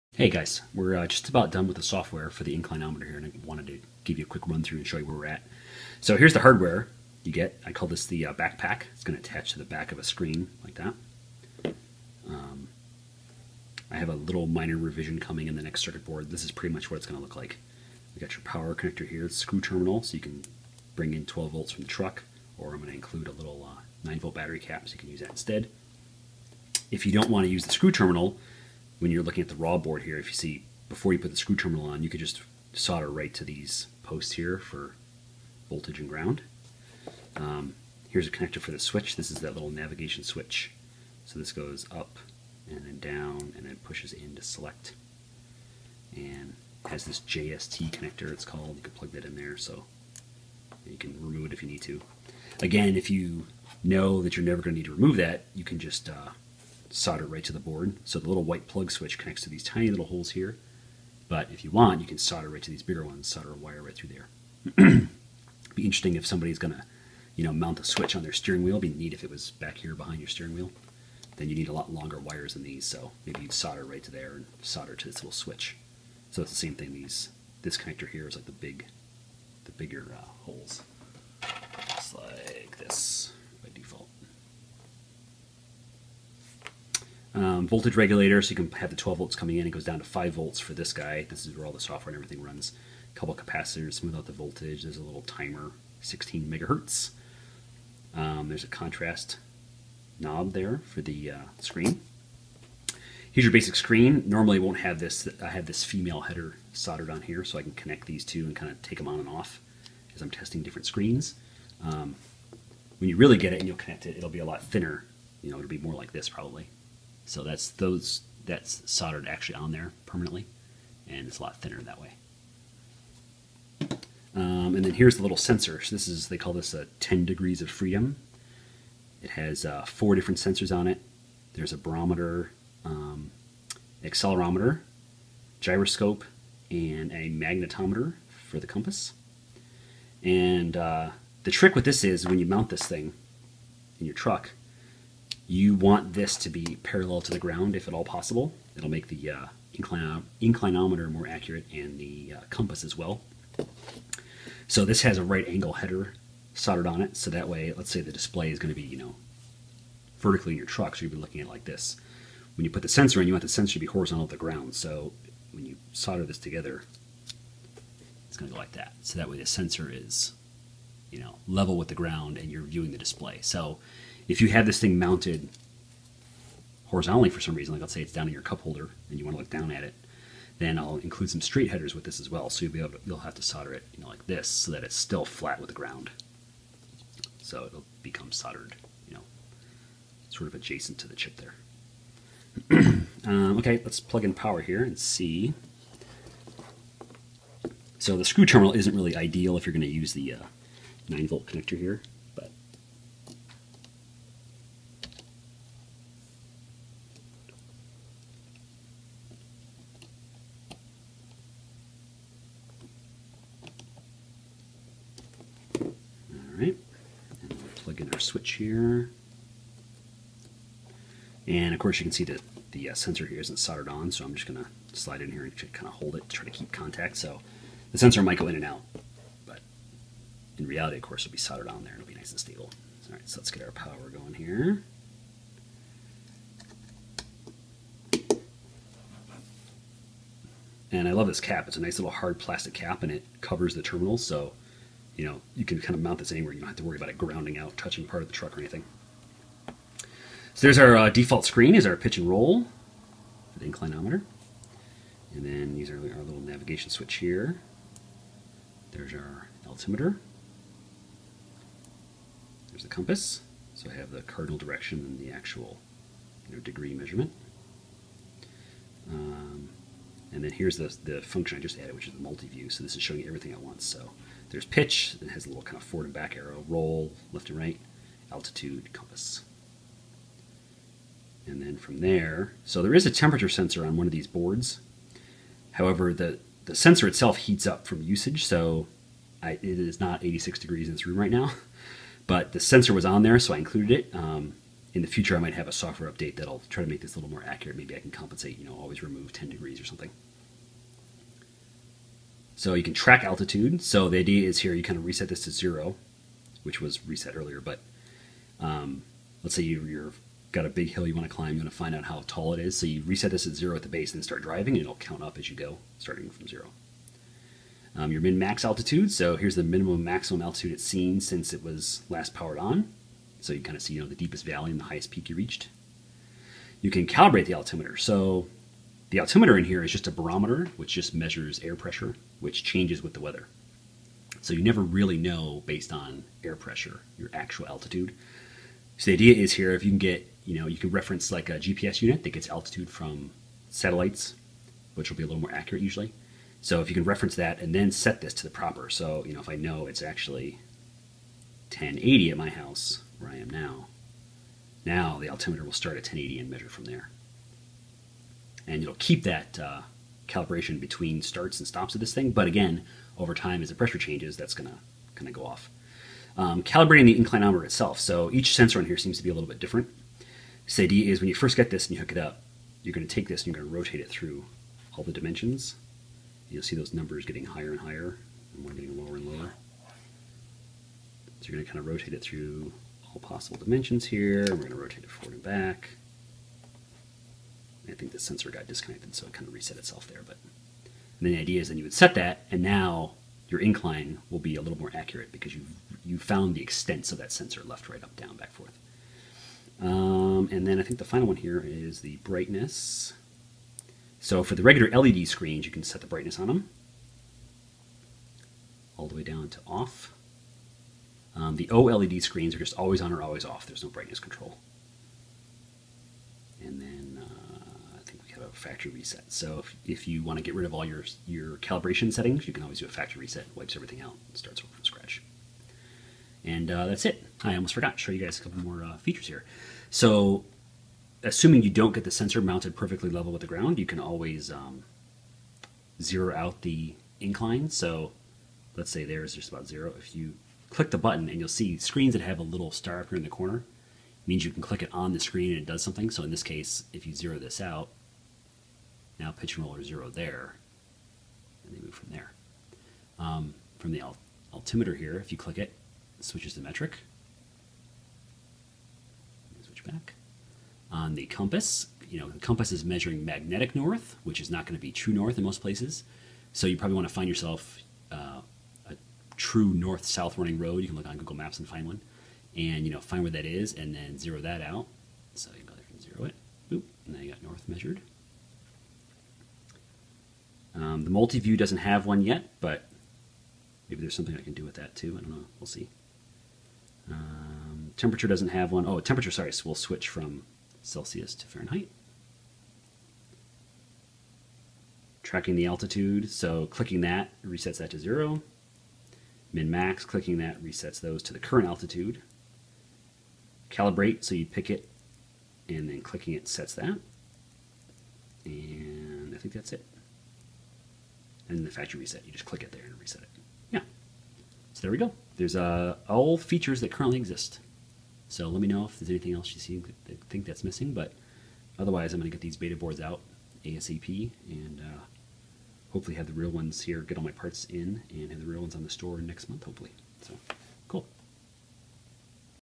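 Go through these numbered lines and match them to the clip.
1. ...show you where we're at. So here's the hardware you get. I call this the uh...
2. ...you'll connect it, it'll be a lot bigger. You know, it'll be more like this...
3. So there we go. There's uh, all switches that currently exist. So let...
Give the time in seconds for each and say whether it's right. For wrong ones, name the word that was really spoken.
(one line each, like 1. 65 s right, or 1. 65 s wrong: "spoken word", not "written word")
1. 4 s right
2. 113 s wrong: "thinner", not "bigger"
3. 514 s wrong: "features", not "switches".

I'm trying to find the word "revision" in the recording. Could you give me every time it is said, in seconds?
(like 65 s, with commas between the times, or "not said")
14 s.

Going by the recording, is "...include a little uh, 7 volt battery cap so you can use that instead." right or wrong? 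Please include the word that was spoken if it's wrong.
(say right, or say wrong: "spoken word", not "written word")
wrong: "9", not "7".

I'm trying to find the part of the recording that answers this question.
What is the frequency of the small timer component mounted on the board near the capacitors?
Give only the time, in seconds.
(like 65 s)
96 s.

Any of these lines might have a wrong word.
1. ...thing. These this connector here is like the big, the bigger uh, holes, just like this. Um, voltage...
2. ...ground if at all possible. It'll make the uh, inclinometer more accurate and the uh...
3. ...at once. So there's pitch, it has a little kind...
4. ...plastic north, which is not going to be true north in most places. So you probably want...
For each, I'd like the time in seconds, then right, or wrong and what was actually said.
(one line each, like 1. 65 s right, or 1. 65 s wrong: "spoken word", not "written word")
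1. 76 s right
2. 147 s right
3. 273 s right
4. 463 s wrong: "magnetic", not "plastic".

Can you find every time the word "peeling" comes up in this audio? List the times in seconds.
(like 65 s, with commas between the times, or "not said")
not said.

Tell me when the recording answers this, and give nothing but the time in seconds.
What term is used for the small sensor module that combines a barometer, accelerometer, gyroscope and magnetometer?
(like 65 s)
127 s.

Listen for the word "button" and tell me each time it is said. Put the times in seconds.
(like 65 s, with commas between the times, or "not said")
440 s.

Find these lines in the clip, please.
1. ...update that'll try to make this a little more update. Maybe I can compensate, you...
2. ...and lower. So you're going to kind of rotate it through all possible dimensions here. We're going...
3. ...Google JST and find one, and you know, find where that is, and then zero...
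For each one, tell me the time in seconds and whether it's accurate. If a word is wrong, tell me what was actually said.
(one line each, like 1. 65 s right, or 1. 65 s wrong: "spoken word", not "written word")
1. 296 s wrong: "accurate", not "update"
2. 379 s right
3. 471 s wrong: "Maps", not "JST".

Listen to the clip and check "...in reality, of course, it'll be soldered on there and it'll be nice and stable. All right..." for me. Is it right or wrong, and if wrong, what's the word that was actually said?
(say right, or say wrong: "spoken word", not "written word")
right.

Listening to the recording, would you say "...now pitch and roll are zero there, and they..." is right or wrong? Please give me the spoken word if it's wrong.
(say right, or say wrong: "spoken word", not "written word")
right.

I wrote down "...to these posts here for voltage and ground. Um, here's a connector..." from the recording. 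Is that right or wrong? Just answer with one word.
right.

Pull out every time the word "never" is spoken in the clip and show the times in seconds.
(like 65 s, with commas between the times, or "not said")
54 s, 334 s.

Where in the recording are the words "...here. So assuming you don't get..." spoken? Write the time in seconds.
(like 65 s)
429 s.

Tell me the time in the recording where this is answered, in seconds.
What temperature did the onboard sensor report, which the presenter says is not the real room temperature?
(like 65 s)
290 s.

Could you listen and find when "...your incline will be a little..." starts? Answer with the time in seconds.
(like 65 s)
393 s.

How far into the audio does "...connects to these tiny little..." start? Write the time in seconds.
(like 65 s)
59 s.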